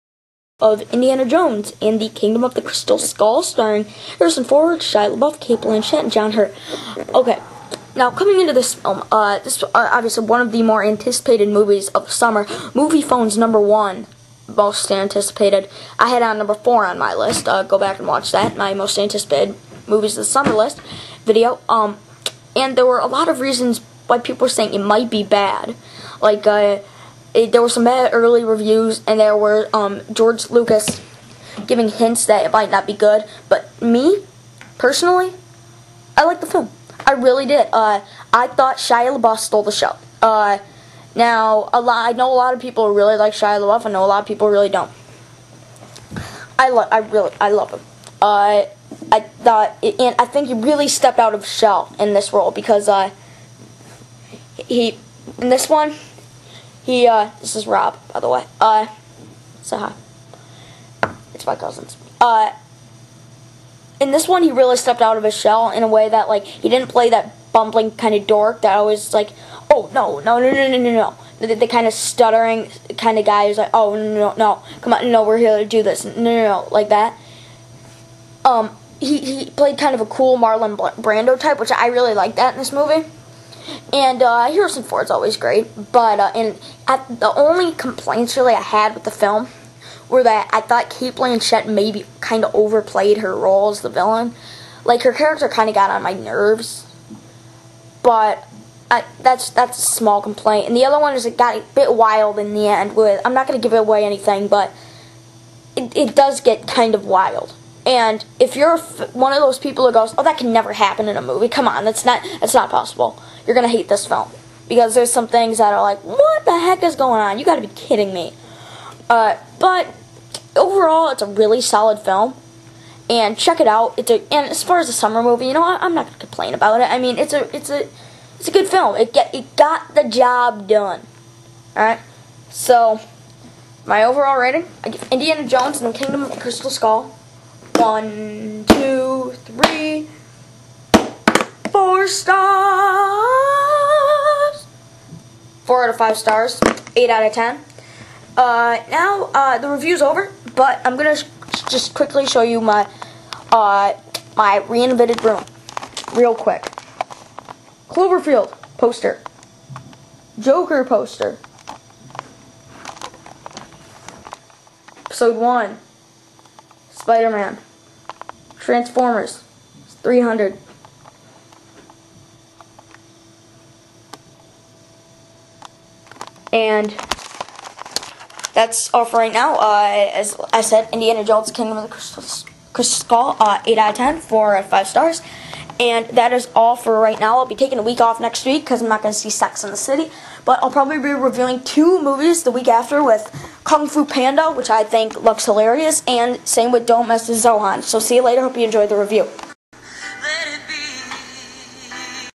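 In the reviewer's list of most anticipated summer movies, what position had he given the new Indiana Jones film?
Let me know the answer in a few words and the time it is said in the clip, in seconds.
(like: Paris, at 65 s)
4, at 16 s.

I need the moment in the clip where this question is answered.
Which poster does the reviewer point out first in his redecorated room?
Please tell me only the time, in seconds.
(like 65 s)
157 s.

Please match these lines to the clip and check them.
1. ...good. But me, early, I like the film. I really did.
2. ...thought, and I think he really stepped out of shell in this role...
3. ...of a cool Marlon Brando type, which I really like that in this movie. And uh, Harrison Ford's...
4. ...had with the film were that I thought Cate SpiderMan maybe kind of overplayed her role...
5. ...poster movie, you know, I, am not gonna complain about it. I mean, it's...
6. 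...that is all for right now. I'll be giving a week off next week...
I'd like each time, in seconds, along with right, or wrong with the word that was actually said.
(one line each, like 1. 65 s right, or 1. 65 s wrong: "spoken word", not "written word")
1. 32 s wrong: "personally", not "early"
2. 49 s right
3. 79 s right
4. 88 s wrong: "Blanchett", not "SpiderMan"
5. 124 s wrong: "summer", not "poster"
6. 186 s wrong: "taking", not "giving".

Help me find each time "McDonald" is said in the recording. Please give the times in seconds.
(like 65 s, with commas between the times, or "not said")
not said.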